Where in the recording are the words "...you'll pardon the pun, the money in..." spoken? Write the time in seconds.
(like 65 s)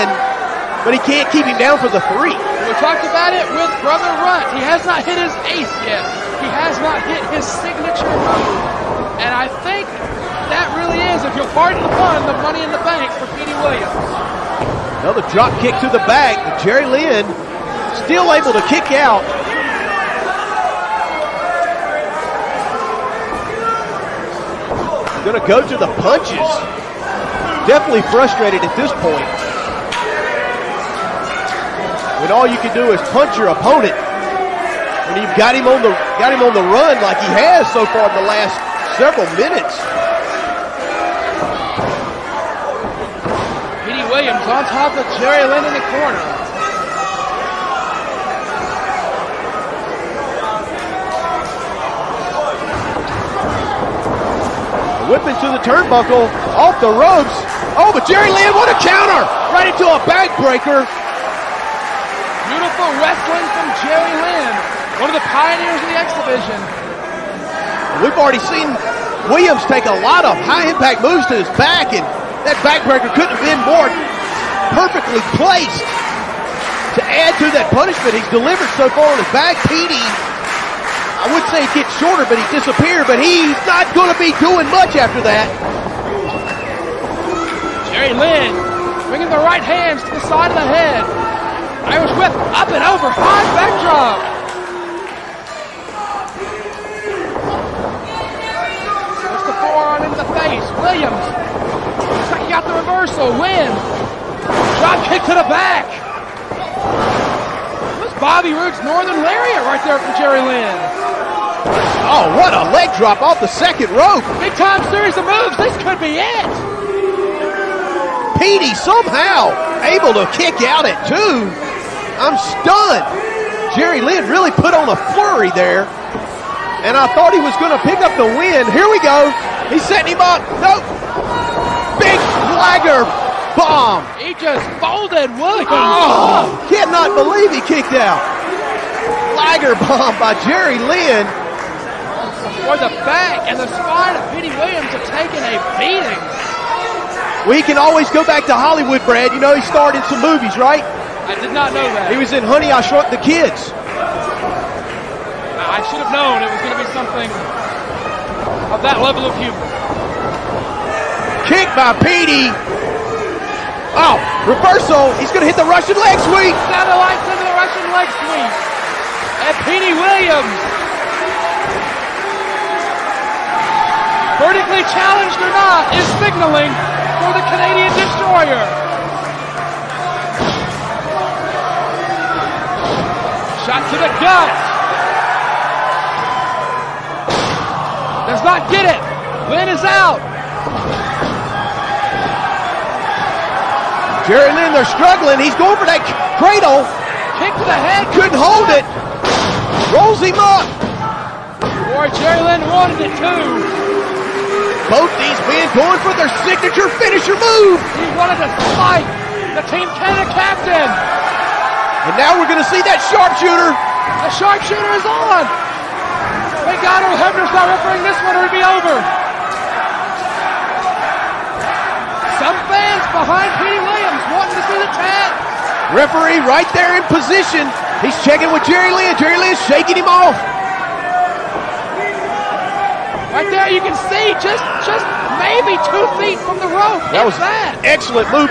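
11 s.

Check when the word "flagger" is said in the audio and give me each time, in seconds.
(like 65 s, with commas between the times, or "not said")
132 s, 139 s.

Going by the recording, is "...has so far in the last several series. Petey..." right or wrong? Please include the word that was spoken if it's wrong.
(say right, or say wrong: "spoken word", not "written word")
wrong: "minutes", not "series".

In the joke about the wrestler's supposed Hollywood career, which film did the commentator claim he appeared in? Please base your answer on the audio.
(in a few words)
Honey, I Shrunk the Kids.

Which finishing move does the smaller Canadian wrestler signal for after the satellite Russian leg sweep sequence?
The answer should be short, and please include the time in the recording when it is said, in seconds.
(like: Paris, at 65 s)
Canadian Destroyer, at 177 s.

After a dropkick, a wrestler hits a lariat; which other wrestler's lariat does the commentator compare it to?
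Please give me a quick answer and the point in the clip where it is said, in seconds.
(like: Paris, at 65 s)
Bobby Roode, at 108 s.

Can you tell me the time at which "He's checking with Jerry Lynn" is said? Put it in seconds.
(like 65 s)
228 s.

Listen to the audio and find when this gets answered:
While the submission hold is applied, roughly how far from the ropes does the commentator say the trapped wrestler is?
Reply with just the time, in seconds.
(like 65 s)
235 s.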